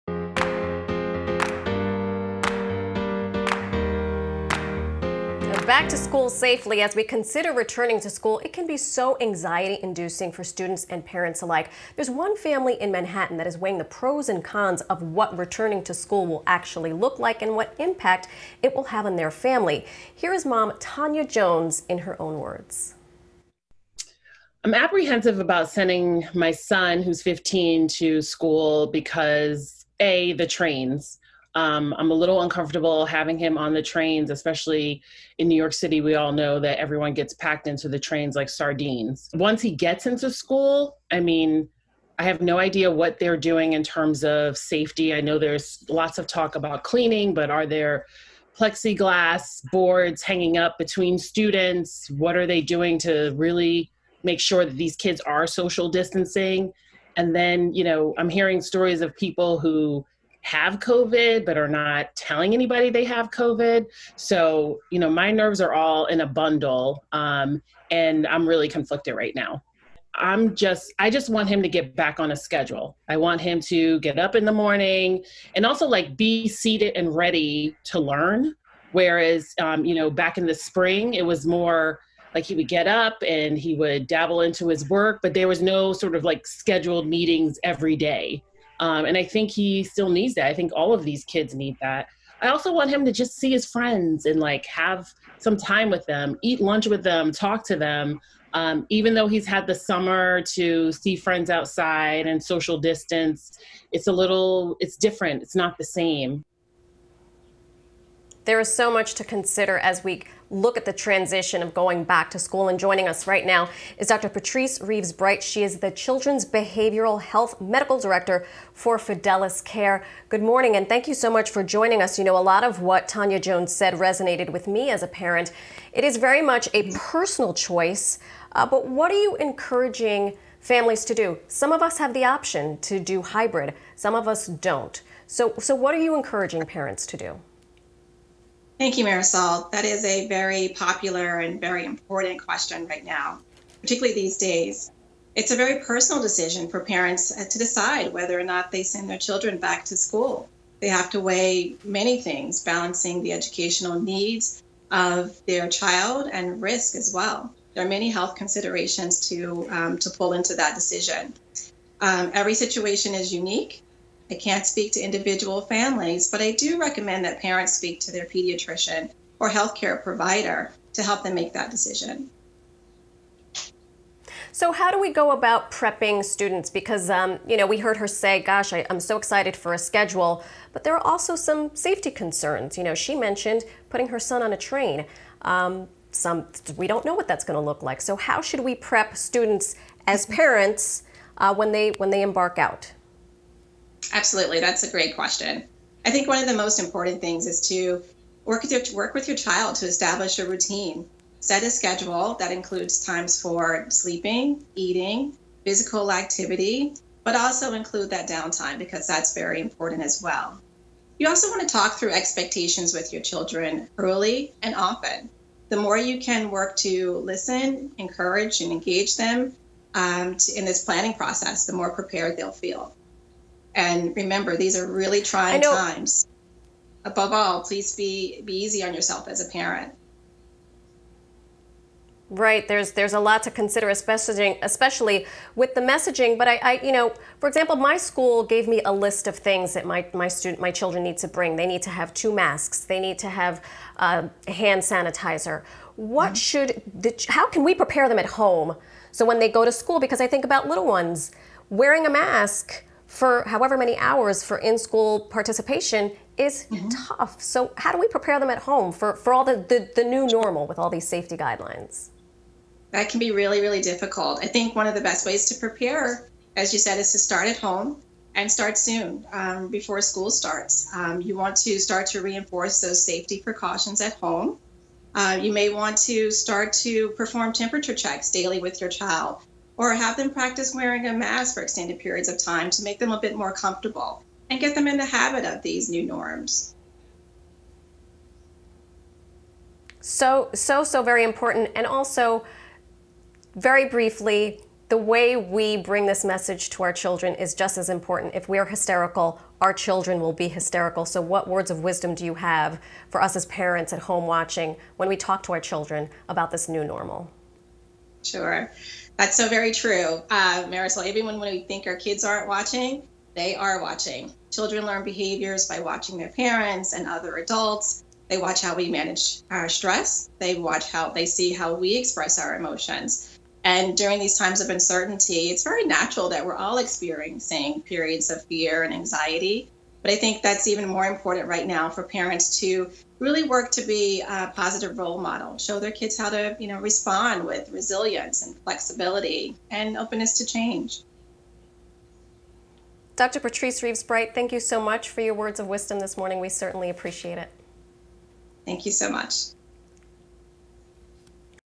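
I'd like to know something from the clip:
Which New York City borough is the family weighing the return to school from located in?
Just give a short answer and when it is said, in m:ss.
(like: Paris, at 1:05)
Manhattan, at 0:12.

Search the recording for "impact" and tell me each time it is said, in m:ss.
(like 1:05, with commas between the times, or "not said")
0:17.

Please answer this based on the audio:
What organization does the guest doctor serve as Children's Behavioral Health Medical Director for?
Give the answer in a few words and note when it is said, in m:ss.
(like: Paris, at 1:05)
Fidelis Care, at 1:58.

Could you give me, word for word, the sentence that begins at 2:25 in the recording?
It's a very personal decision for parents uh, to decide whether or not they send their children back to school.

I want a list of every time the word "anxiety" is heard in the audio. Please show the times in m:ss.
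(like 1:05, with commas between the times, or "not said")
0:09, 5:28.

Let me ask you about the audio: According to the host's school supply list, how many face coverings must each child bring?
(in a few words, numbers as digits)
2.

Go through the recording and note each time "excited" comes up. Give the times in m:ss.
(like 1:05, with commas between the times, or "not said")
2:59.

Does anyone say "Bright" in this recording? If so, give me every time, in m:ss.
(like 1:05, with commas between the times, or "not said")
1:55, 5:44.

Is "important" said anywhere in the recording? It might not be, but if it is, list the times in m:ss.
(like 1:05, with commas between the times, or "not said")
2:21, 3:16, 3:29, 4:51, 4:57, 5:31.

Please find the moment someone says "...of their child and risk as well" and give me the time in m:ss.
2:34.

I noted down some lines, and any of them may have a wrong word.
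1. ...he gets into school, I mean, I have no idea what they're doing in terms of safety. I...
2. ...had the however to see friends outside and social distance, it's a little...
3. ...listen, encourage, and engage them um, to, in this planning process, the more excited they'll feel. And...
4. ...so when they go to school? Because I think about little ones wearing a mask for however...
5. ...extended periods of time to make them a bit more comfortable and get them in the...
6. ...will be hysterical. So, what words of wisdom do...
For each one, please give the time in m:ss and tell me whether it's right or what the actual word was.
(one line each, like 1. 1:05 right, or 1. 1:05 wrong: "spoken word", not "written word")
1. 0:39 right
2. 1:39 wrong: "summer", not "however"
3. 3:37 wrong: "prepared", not "excited"
4. 4:09 right
5. 4:41 right
6. 5:00 right.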